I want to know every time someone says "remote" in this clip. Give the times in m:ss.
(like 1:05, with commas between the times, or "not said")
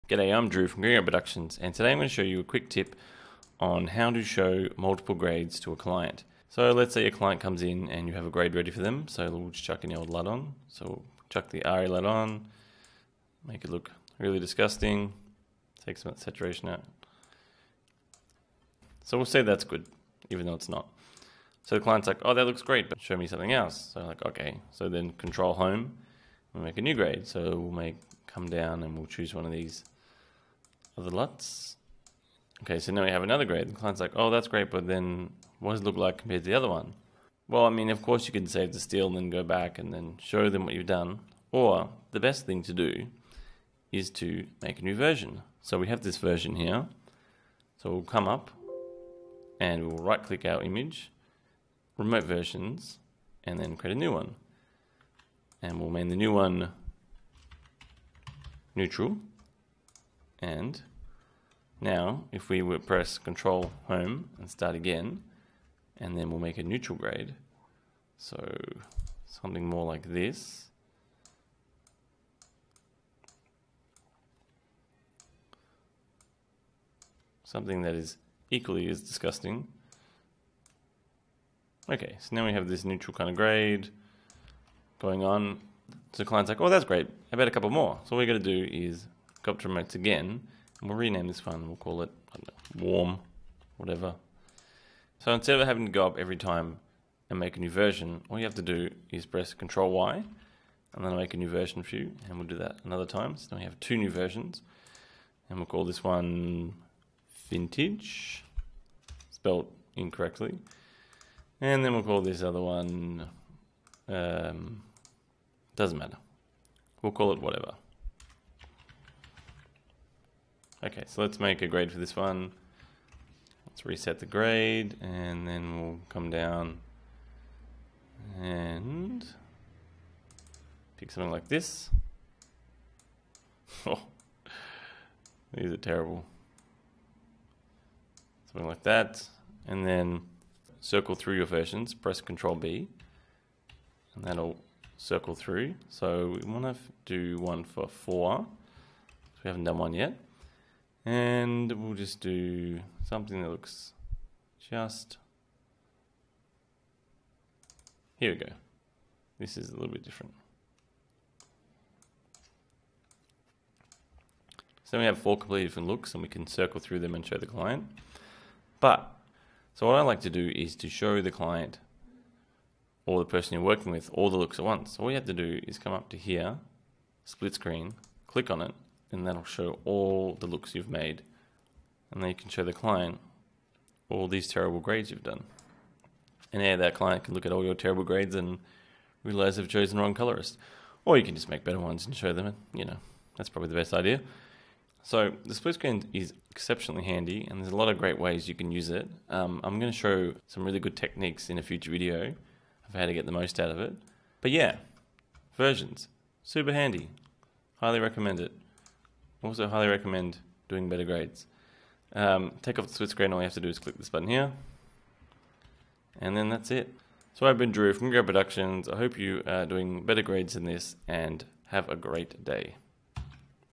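0:51, 1:29.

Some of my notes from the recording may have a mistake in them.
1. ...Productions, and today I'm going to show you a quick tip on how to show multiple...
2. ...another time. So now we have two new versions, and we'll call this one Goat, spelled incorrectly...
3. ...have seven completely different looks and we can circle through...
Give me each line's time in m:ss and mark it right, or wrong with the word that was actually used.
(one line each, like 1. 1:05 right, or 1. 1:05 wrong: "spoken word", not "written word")
1. 0:01 right
2. 1:42 wrong: "Vintage", not "Goat"
3. 2:45 wrong: "four", not "seven".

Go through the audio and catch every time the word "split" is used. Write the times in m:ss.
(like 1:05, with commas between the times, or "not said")
2:57, 3:15, 3:32.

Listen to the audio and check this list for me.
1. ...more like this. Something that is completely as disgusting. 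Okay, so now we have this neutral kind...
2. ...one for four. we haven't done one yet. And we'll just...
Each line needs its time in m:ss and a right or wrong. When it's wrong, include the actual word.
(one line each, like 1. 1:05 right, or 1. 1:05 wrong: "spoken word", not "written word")
1. 1:09 wrong: "equally", not "completely"
2. 2:27 right.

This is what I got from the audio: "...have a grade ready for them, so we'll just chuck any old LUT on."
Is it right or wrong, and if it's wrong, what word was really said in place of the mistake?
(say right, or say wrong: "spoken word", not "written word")
right.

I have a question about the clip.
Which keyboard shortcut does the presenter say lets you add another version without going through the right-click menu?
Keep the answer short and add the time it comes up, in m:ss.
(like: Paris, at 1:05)
Control Y, at 1:39.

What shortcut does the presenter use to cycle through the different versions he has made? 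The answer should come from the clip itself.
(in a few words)
Control B.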